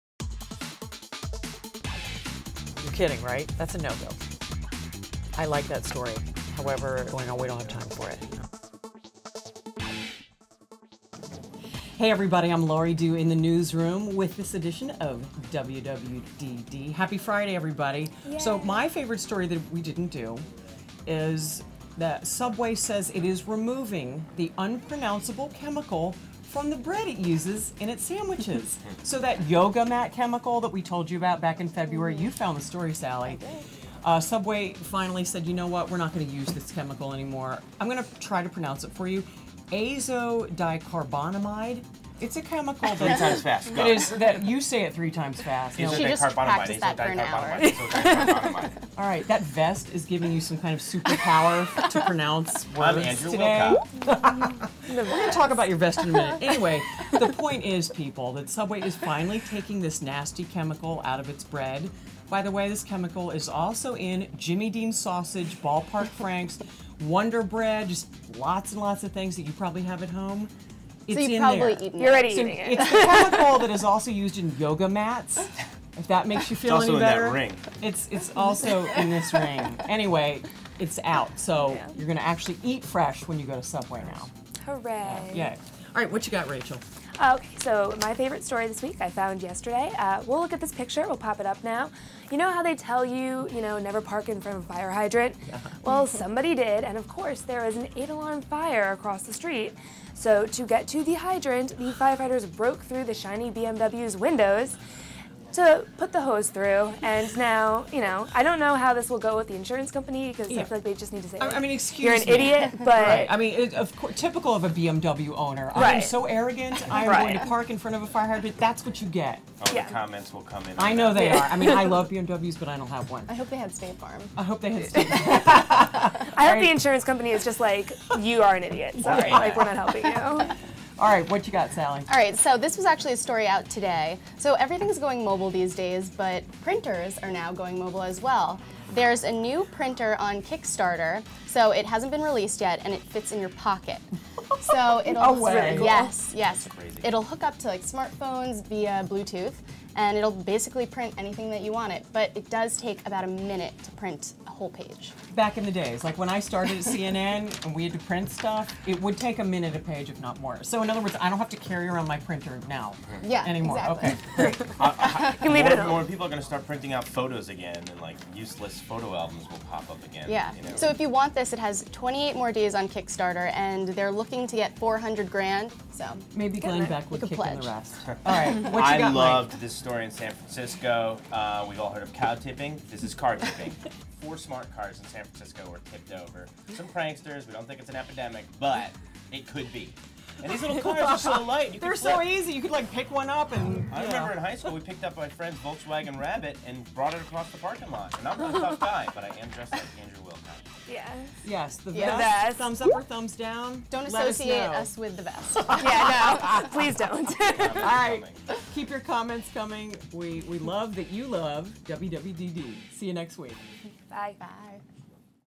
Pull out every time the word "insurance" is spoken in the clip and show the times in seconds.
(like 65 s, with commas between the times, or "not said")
109 s, 126 s.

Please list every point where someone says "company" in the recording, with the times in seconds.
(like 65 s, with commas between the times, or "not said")
109 s, 127 s.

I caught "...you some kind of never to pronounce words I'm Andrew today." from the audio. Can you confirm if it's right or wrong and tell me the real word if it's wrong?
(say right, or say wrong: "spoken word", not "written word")
wrong: "superpower", not "never".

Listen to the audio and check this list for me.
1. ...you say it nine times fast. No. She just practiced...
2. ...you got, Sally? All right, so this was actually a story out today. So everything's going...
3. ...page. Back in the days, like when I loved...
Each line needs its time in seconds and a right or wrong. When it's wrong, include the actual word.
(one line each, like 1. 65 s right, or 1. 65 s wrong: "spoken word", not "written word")
1. 44 s wrong: "three", not "nine"
2. 131 s right
3. 154 s wrong: "started", not "loved".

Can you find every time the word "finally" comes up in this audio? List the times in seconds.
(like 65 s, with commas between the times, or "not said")
34 s, 58 s.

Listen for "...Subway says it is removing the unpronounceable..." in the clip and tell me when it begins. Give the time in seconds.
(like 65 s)
22 s.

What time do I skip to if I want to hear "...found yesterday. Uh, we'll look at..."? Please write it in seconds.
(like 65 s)
89 s.